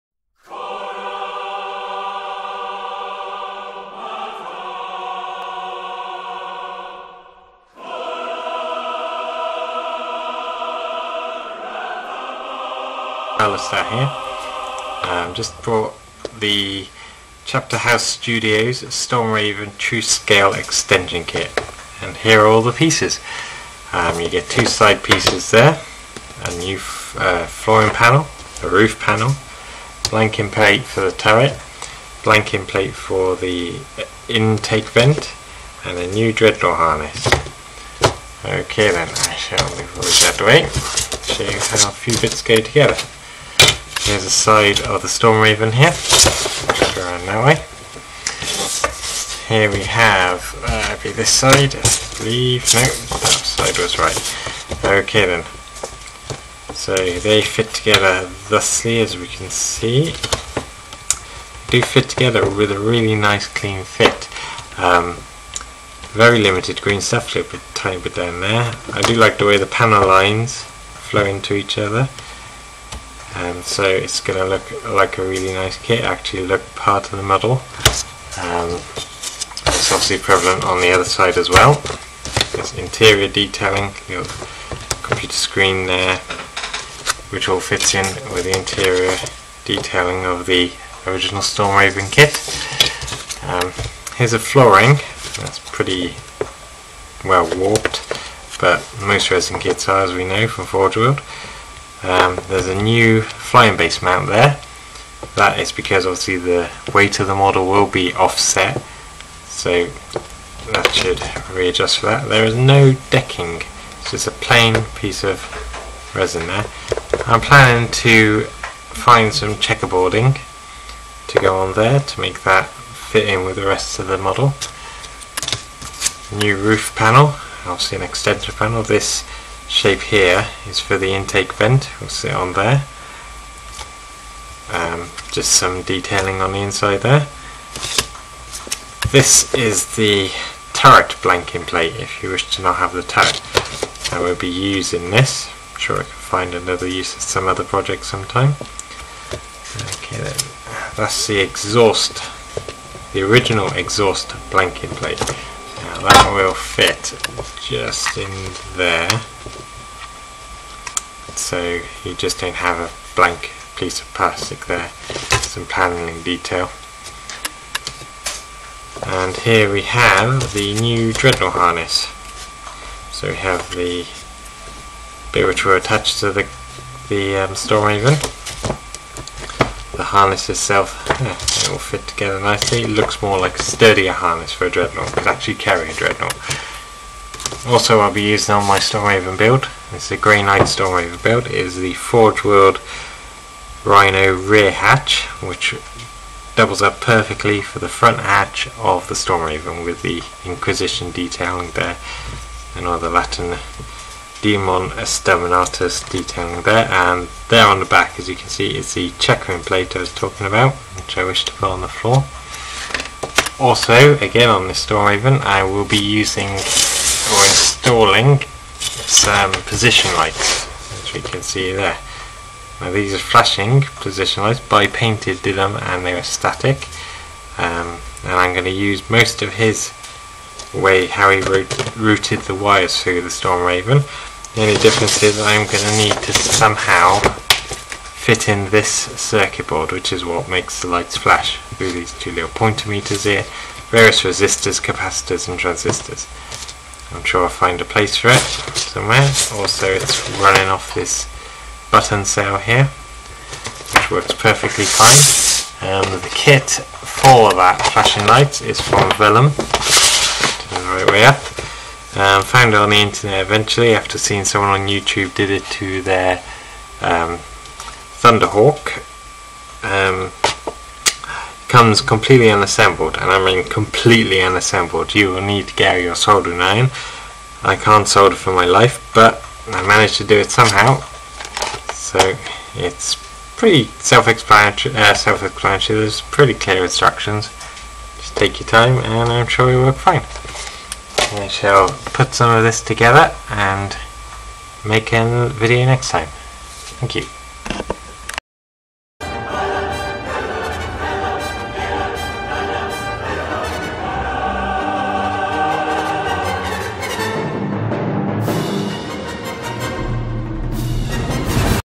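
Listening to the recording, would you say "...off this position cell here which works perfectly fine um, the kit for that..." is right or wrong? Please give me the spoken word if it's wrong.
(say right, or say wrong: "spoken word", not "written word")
wrong: "button", not "position".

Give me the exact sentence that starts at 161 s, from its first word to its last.
So you just don't have a blank piece of plastic there, some panelling detail.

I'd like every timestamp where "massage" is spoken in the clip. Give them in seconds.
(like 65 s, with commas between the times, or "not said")
not said.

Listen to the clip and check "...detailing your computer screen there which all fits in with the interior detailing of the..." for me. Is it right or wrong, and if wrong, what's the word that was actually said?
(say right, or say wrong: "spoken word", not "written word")
right.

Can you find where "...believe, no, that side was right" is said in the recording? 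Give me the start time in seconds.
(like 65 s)
52 s.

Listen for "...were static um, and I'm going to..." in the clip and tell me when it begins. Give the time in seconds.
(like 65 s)
226 s.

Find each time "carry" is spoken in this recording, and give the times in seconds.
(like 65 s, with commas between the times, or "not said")
185 s.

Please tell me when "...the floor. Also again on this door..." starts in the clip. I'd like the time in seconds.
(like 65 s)
211 s.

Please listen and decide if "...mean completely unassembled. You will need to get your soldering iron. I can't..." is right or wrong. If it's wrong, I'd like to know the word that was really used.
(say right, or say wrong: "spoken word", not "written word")
right.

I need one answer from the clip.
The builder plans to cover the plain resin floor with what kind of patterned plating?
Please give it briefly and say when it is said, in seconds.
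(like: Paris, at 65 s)
Checkerboarding, at 119 s.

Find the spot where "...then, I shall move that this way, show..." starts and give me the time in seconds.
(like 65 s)
38 s.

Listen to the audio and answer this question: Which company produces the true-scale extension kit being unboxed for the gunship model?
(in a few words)
Chapter House Studios.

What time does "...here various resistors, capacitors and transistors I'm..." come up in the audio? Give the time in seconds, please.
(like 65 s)
243 s.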